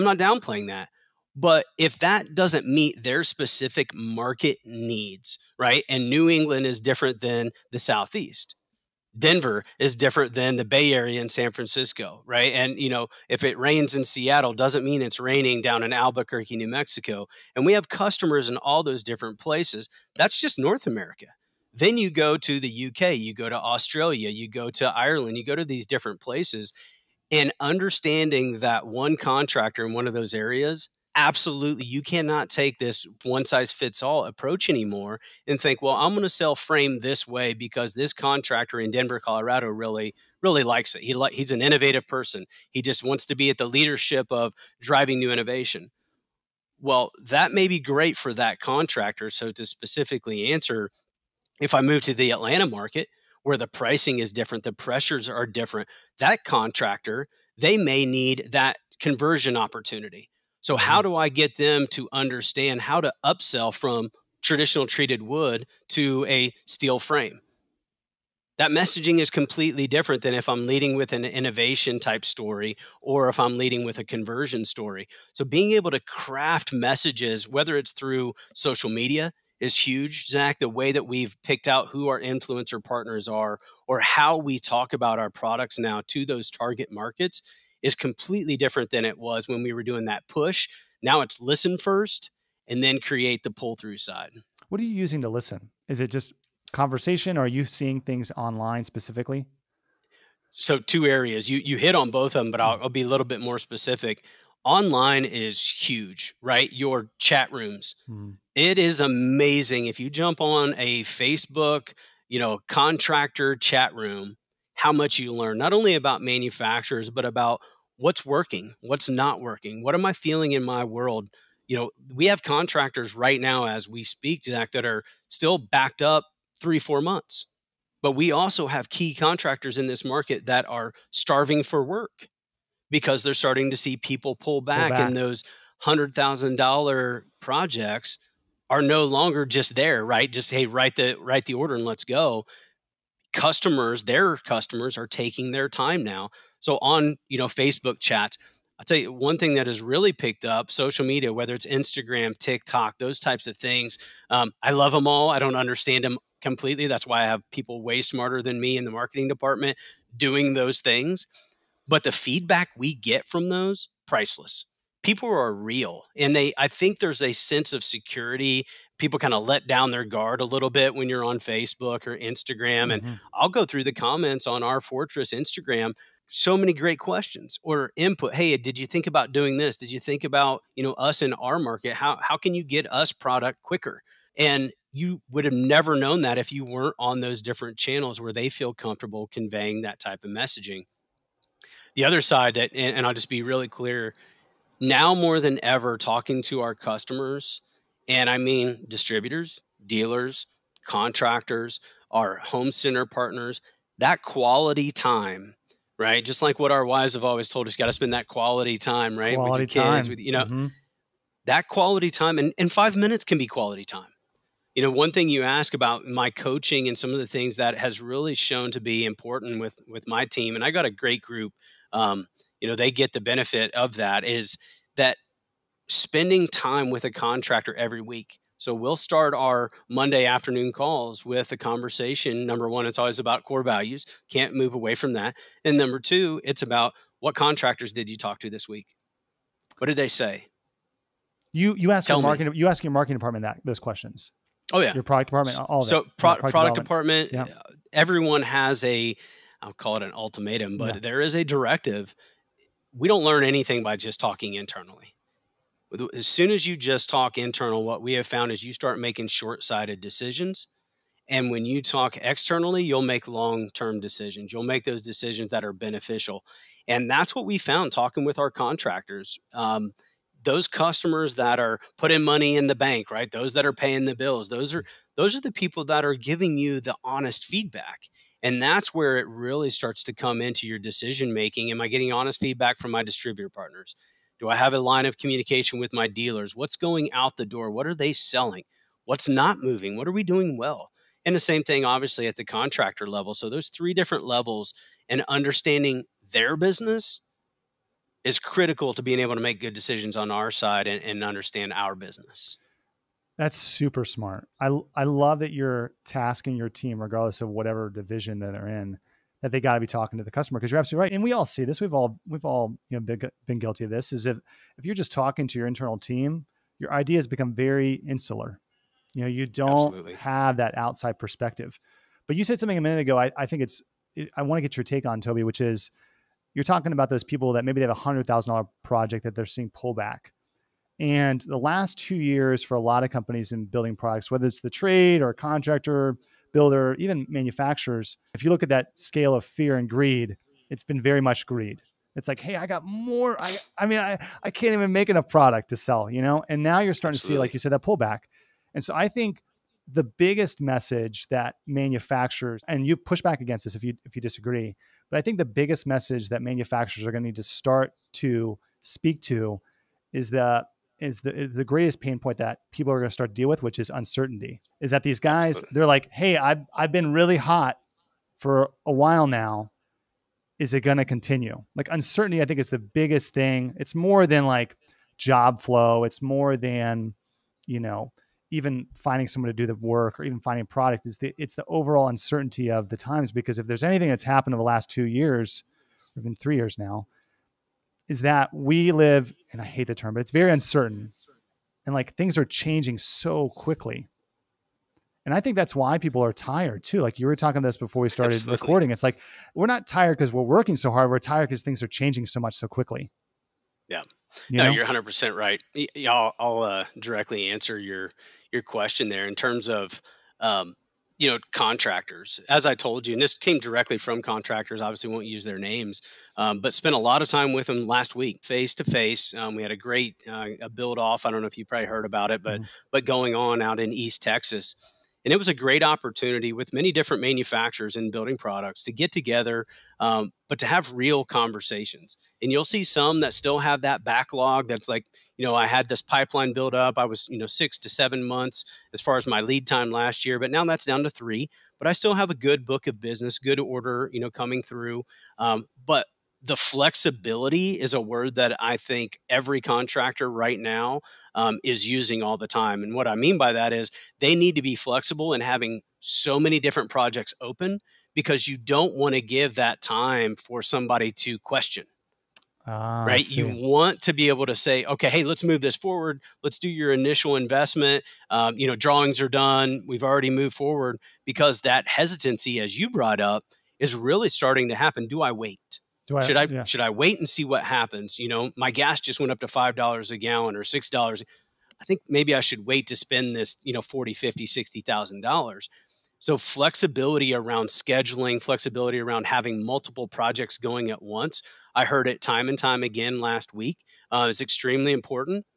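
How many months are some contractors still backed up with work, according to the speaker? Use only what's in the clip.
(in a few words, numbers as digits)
3 to 4 months.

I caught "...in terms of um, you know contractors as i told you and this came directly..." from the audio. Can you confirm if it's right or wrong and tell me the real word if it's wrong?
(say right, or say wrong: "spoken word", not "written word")
right.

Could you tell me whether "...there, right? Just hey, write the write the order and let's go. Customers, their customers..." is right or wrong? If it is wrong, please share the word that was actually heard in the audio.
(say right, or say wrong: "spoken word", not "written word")
right.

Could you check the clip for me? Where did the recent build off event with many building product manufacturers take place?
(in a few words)
East Texas.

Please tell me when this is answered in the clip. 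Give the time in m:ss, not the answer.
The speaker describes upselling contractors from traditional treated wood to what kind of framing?
1:06.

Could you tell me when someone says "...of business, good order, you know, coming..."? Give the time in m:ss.
7:22.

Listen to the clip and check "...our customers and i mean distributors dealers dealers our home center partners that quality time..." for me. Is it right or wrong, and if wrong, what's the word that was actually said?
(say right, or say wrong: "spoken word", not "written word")
wrong: "contractors", not "dealers".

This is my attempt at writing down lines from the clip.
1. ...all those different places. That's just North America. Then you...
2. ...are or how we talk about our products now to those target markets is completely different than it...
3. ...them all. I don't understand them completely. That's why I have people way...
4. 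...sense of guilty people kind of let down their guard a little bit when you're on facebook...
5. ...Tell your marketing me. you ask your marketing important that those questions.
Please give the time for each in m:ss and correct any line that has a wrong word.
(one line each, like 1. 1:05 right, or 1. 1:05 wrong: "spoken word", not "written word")
1. 0:18 right
2. 1:23 right
3. 2:34 right
4. 2:47 wrong: "security", not "guilty"
5. 4:02 wrong: "department", not "important".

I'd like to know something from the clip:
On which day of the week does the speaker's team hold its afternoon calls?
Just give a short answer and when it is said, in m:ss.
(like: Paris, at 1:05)
Monday, at 3:49.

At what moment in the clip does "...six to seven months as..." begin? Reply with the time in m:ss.
7:17.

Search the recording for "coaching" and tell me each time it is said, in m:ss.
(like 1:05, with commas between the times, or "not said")
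3:36.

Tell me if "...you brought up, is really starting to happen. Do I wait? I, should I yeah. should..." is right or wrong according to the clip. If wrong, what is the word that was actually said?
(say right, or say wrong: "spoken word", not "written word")
right.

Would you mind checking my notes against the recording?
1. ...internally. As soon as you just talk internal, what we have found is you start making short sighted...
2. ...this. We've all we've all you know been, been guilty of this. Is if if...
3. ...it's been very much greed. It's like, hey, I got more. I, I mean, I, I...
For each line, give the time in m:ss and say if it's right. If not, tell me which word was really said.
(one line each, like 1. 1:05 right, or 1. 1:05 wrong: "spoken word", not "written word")
1. 4:14 right
2. 5:11 right
3. 5:40 right.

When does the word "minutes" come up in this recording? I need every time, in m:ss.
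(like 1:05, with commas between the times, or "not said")
3:32, 5:22.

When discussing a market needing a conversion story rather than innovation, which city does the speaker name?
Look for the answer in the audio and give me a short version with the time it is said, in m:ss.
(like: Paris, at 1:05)
Atlanta, at 0:52.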